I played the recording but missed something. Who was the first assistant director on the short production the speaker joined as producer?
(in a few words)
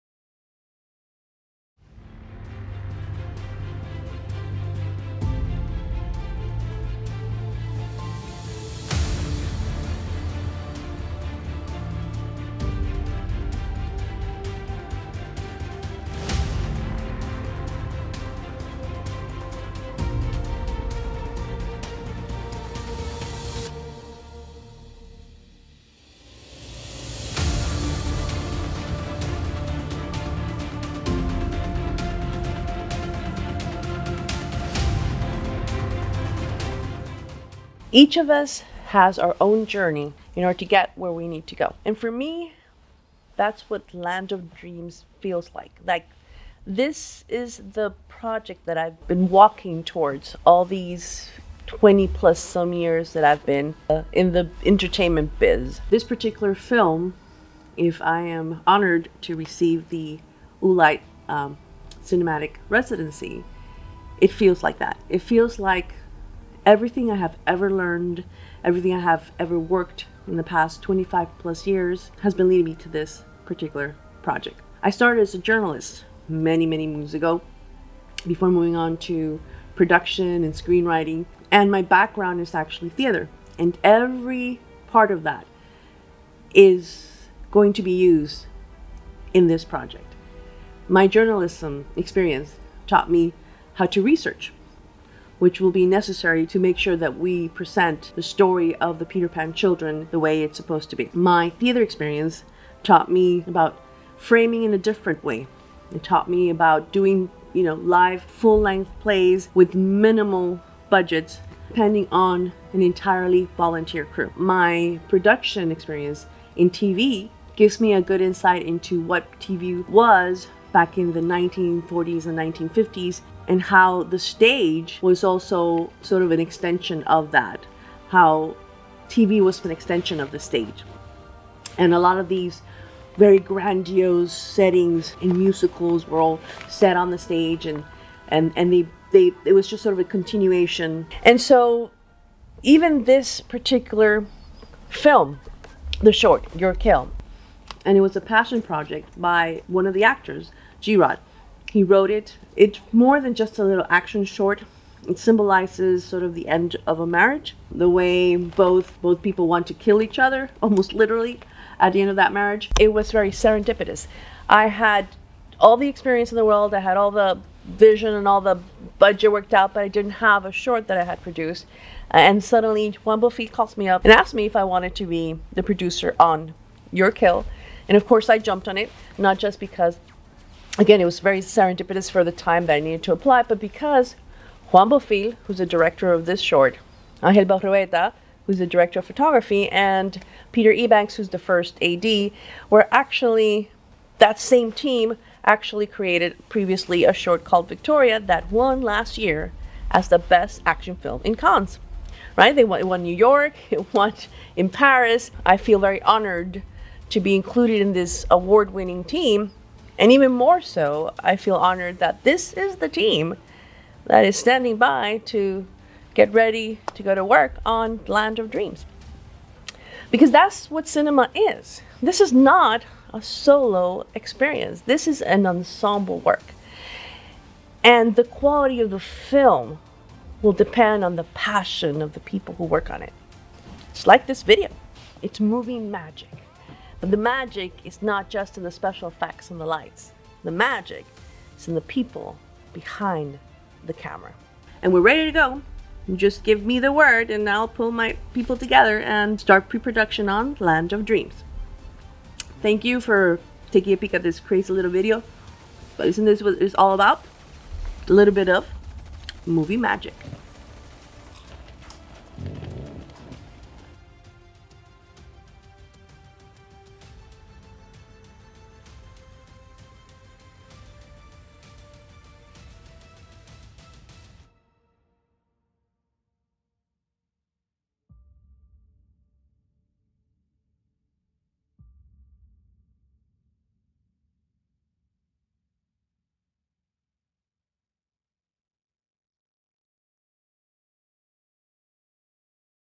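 Peter Ebanks.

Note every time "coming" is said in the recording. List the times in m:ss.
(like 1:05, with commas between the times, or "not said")
not said.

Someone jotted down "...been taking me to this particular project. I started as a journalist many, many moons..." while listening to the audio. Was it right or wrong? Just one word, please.
wrong.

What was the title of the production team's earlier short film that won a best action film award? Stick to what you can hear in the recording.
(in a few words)
Victoria.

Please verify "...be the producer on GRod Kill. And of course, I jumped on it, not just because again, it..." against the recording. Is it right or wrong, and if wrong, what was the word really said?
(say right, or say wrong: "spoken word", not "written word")
wrong: "Your", not "GRod".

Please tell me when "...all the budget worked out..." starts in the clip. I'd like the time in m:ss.
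2:48.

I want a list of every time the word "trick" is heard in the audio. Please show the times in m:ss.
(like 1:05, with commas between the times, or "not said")
not said.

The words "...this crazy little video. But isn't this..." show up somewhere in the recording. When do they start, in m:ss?
4:14.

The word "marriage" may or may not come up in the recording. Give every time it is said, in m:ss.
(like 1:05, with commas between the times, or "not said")
2:37, 2:42.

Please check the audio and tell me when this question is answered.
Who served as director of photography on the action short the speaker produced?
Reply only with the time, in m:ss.
3:07.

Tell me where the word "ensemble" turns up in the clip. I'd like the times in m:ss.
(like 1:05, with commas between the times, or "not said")
3:45.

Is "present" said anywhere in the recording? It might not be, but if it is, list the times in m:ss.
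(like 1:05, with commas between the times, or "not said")
1:37.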